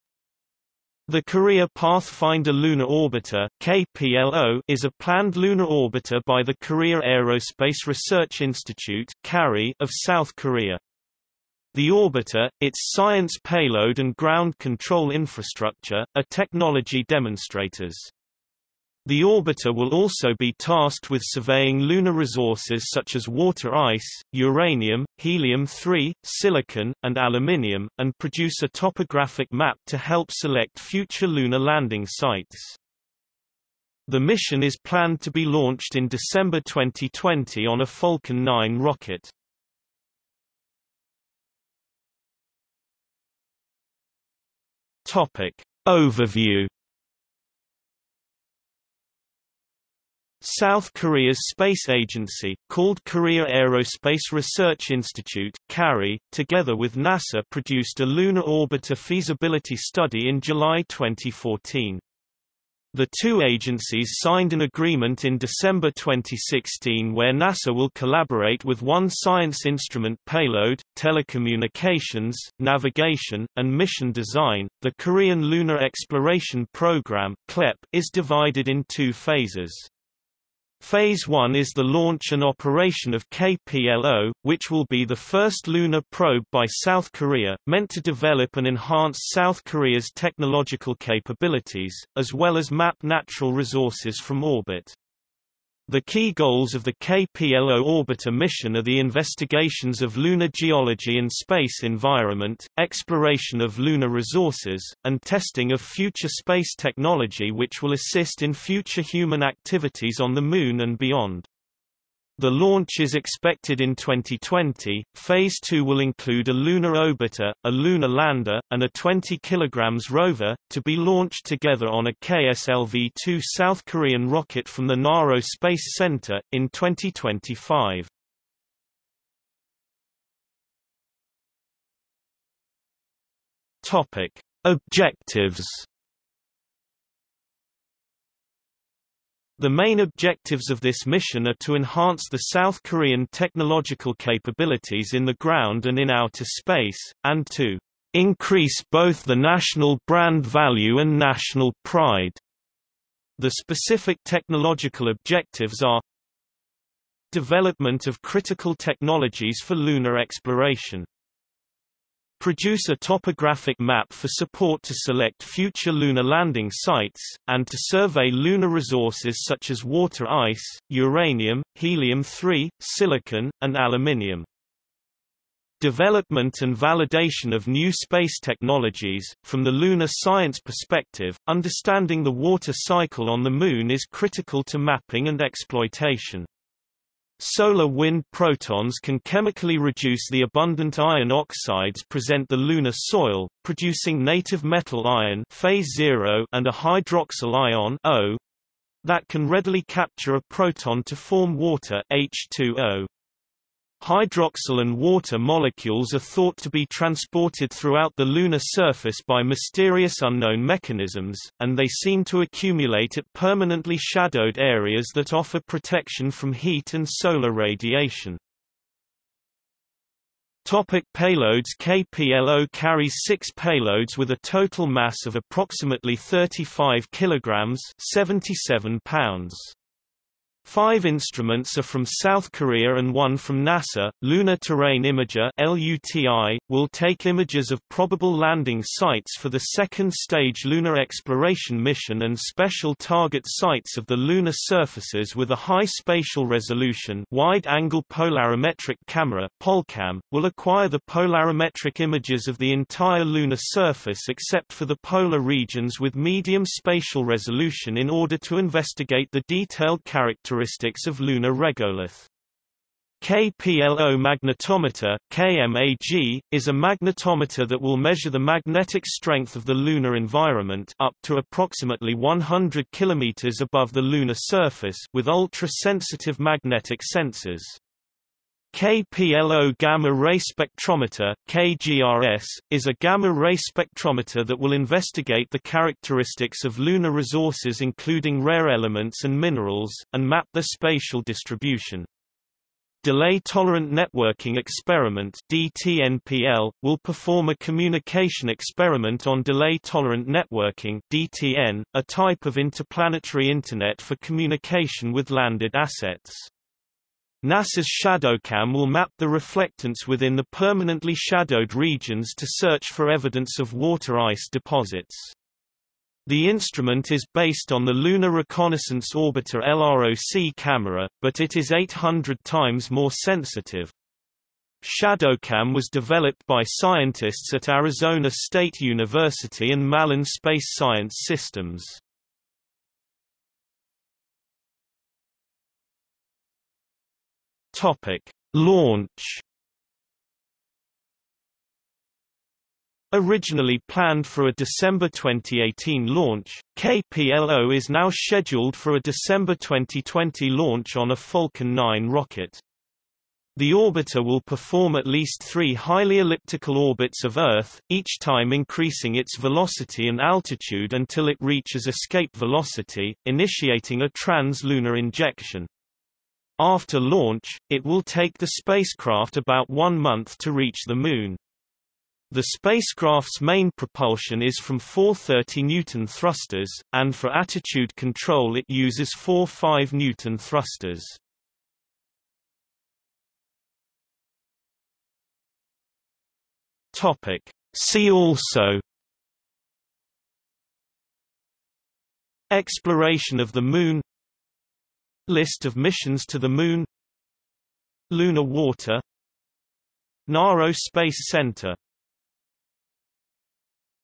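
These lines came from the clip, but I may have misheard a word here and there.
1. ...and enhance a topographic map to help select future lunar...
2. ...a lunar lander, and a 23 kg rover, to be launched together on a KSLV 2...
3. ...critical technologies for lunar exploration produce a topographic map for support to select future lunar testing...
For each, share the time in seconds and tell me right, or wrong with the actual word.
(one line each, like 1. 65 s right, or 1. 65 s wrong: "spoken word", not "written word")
1. 27 s wrong: "produce", not "enhance"
2. 117 s wrong: "20", not "23"
3. 158 s wrong: "landing", not "testing".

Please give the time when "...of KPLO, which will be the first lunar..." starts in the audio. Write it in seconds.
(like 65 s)
83 s.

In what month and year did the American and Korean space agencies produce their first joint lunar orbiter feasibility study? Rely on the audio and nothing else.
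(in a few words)
July 2014.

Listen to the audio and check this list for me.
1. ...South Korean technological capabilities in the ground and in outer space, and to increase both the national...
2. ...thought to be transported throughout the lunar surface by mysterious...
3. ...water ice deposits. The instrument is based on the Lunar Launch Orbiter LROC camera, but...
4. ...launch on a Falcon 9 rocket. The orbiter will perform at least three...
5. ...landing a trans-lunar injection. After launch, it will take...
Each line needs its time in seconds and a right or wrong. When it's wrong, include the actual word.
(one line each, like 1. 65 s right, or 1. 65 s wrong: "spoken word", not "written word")
1. 142 s right
2. 206 s right
3. 313 s wrong: "Reconnaissance", not "Launch"
4. 350 s right
5. 363 s wrong: "initiating", not "landing".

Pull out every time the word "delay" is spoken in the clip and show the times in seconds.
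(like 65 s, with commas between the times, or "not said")
293 s, 299 s.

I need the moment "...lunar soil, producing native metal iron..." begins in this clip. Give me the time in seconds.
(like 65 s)
192 s.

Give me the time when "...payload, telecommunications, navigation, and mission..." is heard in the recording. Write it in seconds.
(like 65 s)
70 s.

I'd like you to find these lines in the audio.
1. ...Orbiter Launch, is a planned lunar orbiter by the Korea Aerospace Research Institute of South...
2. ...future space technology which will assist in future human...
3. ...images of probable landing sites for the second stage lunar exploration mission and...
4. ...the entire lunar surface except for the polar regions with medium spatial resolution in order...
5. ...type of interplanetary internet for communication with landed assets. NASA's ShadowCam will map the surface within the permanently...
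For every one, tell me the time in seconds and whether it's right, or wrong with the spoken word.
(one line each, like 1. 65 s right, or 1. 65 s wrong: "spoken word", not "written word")
1. 2 s wrong: "KPLO", not "Launch"
2. 105 s right
3. 237 s right
4. 252 s right
5. 302 s wrong: "reflectance", not "surface".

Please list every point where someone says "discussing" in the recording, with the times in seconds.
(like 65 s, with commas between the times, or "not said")
not said.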